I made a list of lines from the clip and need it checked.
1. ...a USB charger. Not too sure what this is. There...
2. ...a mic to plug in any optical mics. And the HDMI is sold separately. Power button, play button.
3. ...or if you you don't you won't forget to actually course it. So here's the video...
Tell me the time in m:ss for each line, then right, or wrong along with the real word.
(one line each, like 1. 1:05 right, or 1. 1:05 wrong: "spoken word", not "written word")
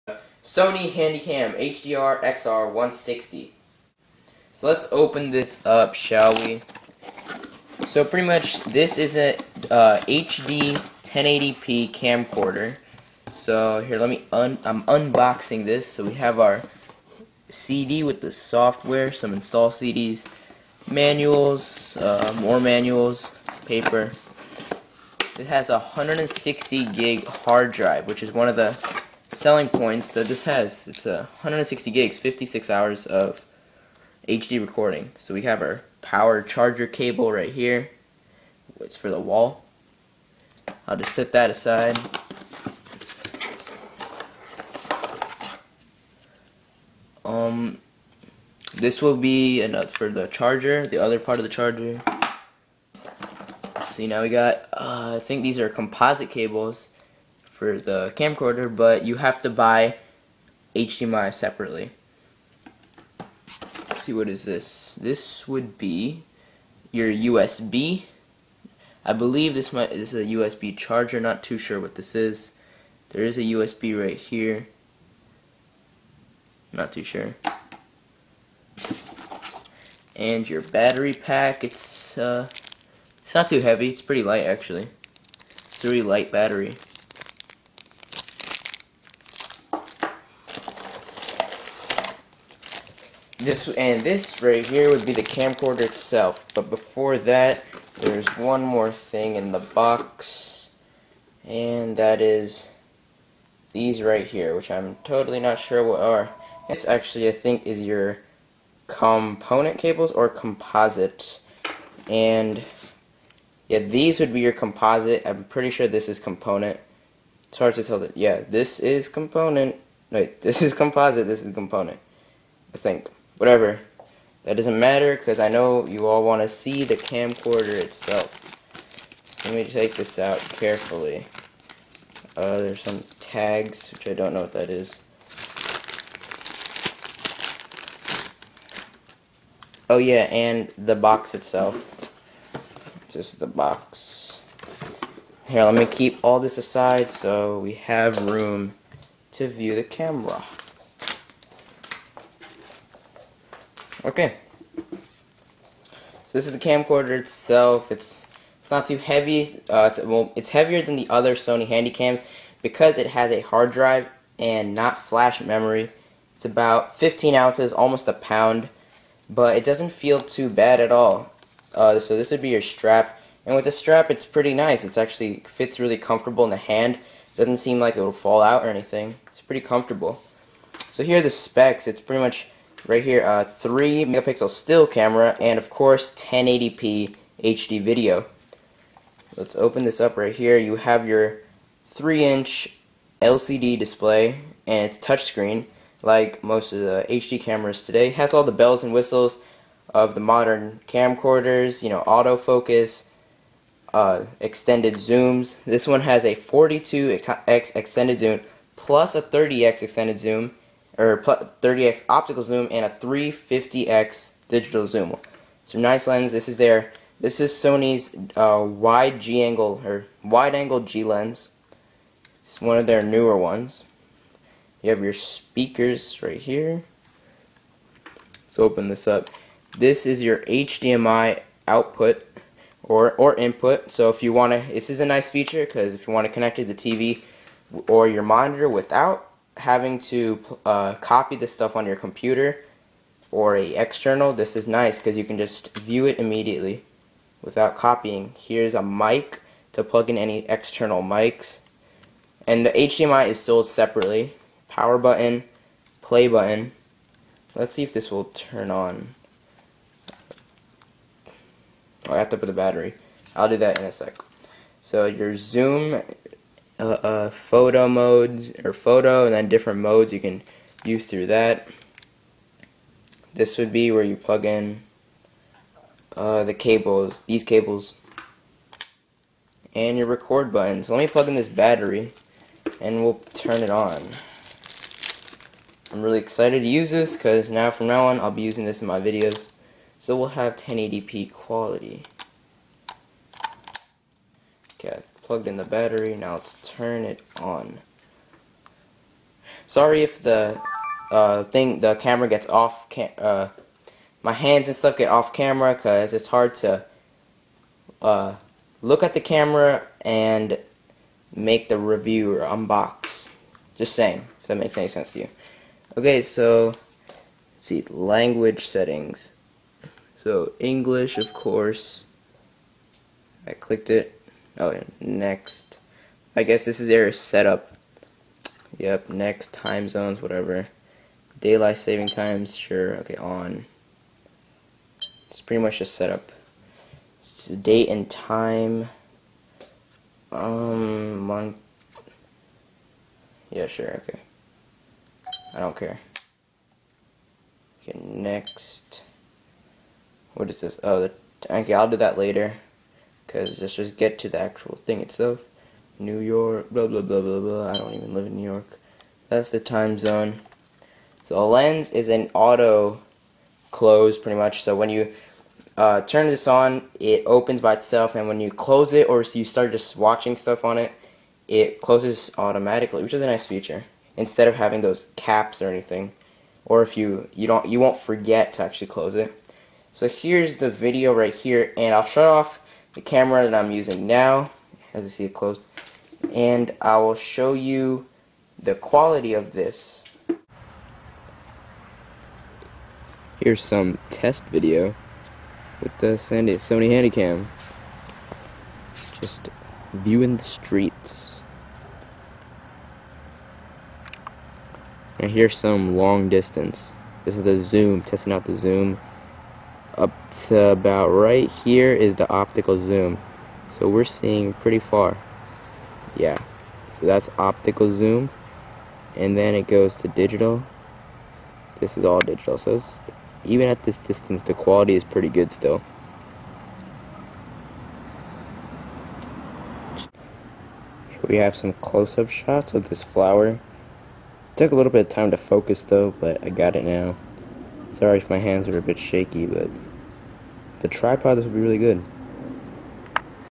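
1. 1:10 right
2. 4:08 wrong: "external", not "optical"
3. 6:16 wrong: "close", not "course".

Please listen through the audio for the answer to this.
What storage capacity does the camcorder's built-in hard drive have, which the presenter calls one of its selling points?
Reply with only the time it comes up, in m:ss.
0:25.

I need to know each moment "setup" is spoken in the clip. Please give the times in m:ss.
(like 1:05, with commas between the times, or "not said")
5:27, 5:35.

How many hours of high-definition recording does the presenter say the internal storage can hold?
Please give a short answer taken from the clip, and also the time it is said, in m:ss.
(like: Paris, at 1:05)
56 hours, at 0:32.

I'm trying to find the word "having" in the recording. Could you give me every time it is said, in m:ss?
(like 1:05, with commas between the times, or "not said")
3:59, 6:14.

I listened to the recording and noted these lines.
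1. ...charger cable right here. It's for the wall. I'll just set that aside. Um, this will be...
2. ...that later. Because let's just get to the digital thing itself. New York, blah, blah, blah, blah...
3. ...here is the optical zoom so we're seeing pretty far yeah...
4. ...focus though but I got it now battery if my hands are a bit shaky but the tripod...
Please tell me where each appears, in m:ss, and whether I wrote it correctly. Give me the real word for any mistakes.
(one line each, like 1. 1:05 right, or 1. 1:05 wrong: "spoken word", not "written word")
1. 0:36 right
2. 5:51 wrong: "actual", not "digital"
3. 6:51 right
4. 7:15 wrong: "sorry", not "battery".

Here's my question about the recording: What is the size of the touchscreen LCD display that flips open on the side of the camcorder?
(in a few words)
3 inch.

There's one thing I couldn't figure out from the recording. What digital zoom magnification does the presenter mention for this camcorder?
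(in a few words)
350x.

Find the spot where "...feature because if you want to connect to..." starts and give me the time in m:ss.
3:55.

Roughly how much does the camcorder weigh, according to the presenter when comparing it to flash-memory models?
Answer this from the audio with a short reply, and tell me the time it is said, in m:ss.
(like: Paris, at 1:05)
15 ounces, at 2:46.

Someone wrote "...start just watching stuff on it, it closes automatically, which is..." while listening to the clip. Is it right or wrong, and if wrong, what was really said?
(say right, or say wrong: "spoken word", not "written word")
right.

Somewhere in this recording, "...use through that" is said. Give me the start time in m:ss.
4:30.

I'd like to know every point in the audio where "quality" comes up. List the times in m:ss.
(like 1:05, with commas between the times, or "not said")
4:51, 6:28, 7:04.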